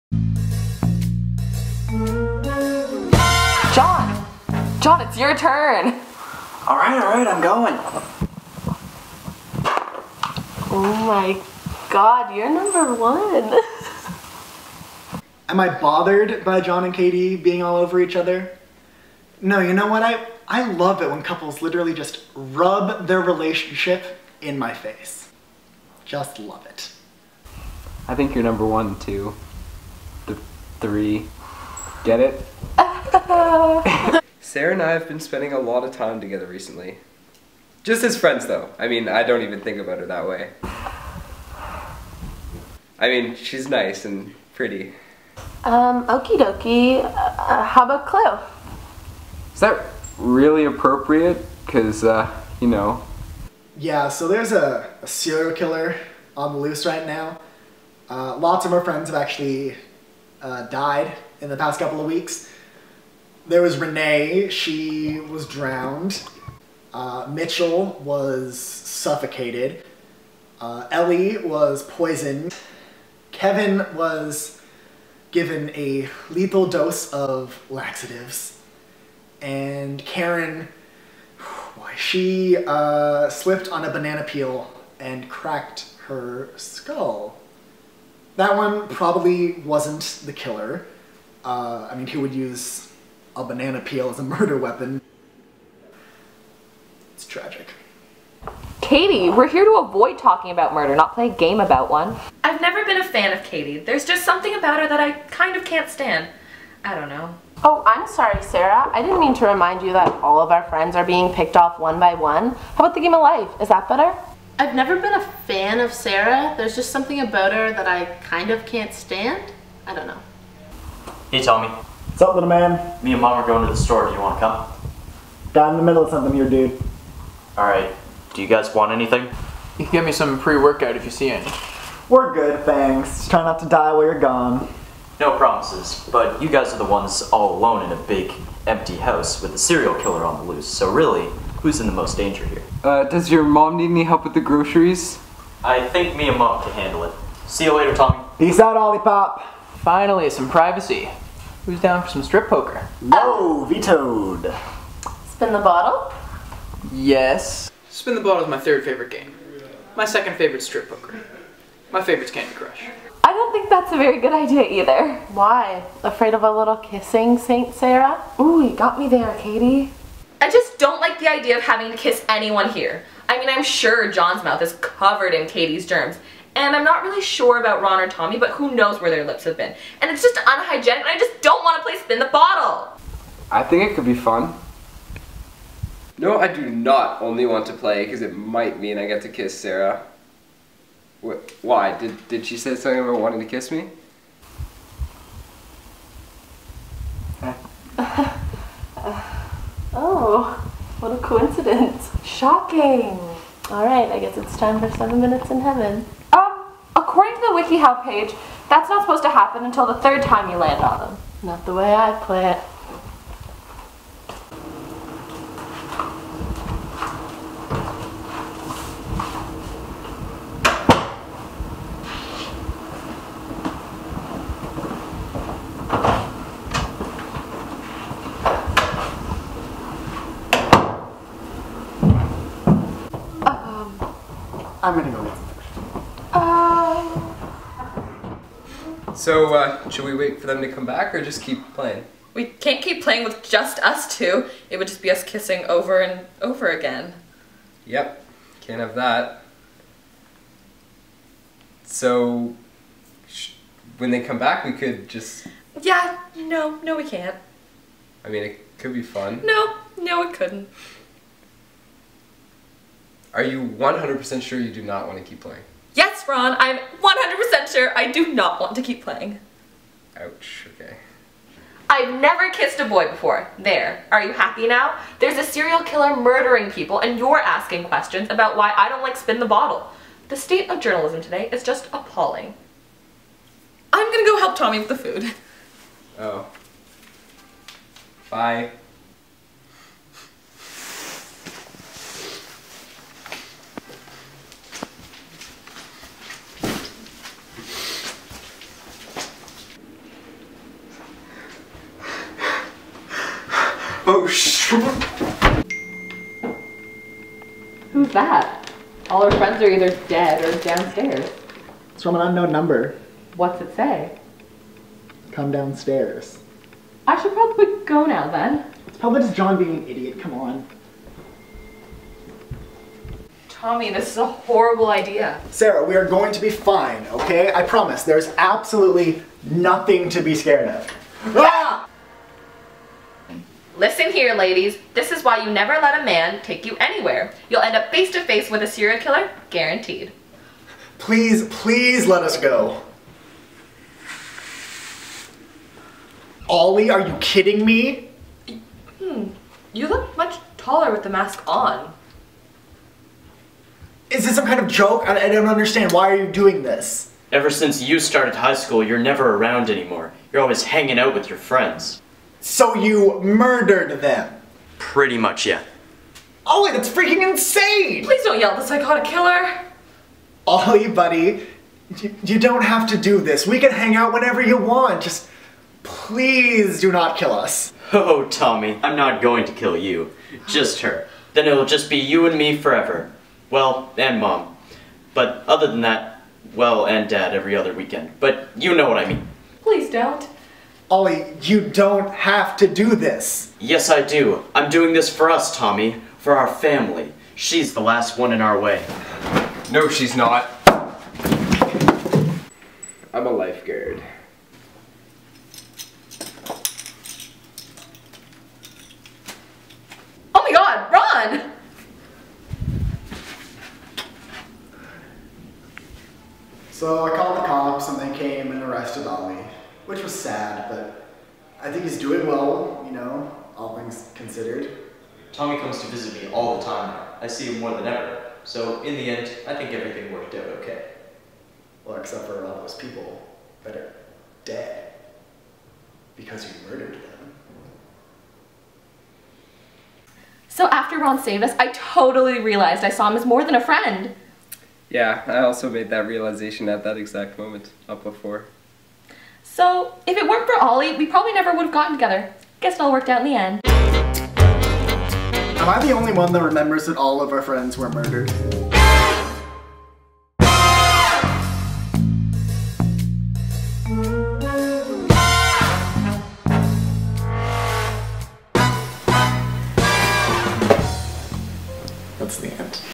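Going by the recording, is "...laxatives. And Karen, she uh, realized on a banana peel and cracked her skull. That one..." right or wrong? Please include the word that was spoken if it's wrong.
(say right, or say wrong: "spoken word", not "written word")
wrong: "slipped", not "realized".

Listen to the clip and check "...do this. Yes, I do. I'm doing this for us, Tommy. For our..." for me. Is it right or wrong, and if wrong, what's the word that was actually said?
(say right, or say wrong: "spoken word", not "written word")
right.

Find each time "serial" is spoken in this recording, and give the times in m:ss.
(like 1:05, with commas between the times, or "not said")
0:55, 2:19, 4:35, 5:38.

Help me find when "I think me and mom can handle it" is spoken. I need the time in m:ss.
2:25.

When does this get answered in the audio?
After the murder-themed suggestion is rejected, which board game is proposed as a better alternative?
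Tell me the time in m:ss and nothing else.
1:52.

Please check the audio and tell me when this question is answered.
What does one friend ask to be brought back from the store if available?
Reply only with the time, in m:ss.
2:10.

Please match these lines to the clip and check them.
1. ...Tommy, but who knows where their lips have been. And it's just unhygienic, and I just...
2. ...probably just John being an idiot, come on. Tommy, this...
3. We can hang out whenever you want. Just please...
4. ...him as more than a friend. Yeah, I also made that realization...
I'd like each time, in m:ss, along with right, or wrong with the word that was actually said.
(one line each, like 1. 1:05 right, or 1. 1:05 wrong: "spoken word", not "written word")
1. 2:58 right
2. 5:18 right
3. 6:13 right
4. 7:23 right.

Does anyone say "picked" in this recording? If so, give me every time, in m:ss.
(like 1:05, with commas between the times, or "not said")
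1:51.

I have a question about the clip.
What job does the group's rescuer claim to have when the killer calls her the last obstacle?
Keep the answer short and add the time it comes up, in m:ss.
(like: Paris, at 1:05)
Lifeguard, at 6:43.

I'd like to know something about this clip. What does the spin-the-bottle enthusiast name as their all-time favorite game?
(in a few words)
Candy Crush.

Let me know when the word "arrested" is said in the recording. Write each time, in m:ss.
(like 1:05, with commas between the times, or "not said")
6:58.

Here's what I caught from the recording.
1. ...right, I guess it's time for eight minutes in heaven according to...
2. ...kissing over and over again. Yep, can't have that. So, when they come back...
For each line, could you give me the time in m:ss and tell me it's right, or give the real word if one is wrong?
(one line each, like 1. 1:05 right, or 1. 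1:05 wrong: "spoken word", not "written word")
1. 3:23 wrong: "seven", not "eight"
2. 4:05 right.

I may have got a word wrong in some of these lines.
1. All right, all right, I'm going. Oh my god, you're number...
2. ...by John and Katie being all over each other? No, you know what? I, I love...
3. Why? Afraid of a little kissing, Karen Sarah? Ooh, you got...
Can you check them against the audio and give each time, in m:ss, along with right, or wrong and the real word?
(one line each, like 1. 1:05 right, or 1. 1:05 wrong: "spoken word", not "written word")
1. 0:06 right
2. 0:16 right
3. 2:45 wrong: "Saint", not "Karen".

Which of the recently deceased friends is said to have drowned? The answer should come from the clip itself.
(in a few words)
Renee.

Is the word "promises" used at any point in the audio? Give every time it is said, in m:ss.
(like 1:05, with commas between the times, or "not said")
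2:15, 5:27.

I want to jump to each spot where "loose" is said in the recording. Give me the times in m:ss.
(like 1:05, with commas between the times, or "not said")
0:56, 2:20.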